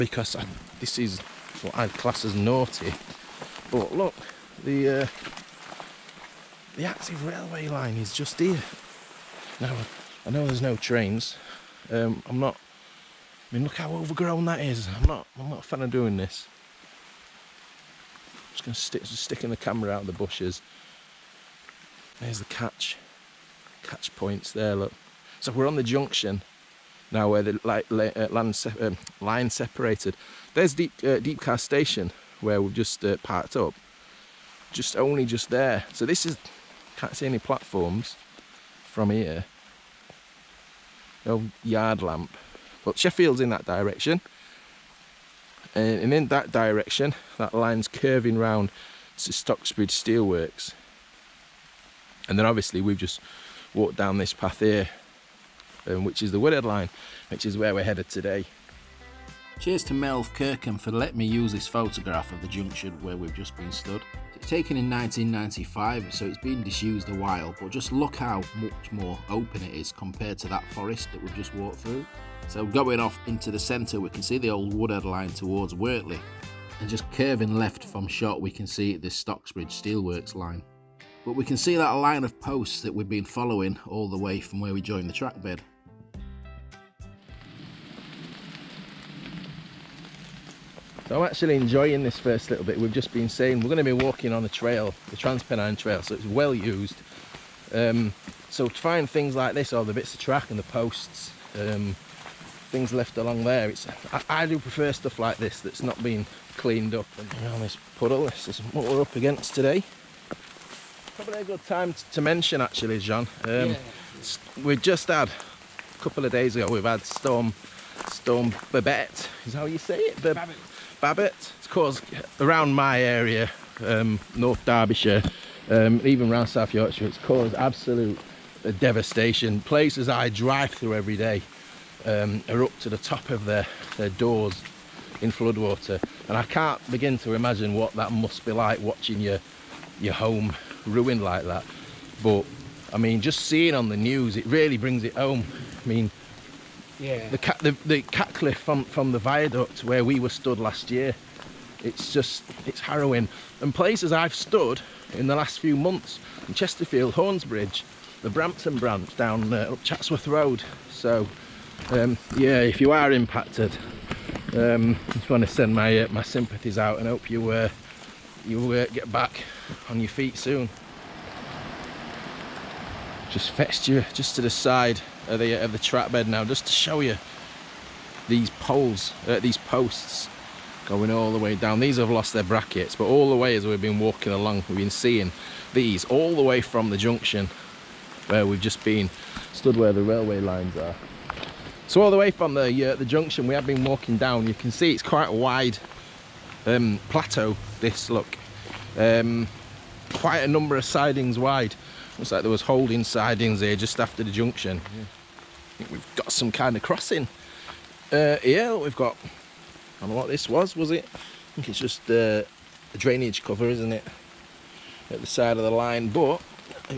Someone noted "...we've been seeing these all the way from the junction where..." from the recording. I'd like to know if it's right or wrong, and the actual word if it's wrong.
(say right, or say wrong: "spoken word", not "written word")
right.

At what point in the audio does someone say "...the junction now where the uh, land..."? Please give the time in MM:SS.
00:25.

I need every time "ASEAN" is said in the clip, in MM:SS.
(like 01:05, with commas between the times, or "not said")
not said.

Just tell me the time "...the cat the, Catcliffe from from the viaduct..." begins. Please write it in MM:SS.
02:27.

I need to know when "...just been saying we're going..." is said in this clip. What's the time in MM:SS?
01:32.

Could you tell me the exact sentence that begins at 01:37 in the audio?
Um, so to find things like this, or the bits of track and the posts, um, things left along there.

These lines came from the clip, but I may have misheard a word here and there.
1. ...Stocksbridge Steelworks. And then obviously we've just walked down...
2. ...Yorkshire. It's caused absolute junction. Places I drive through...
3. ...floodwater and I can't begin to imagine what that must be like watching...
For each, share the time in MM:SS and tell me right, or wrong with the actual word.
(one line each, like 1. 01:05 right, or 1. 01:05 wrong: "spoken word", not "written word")
1. 00:49 right
2. 02:06 wrong: "devastation", not "junction"
3. 02:15 right.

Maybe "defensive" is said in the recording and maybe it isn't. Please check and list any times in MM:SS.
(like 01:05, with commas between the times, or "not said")
not said.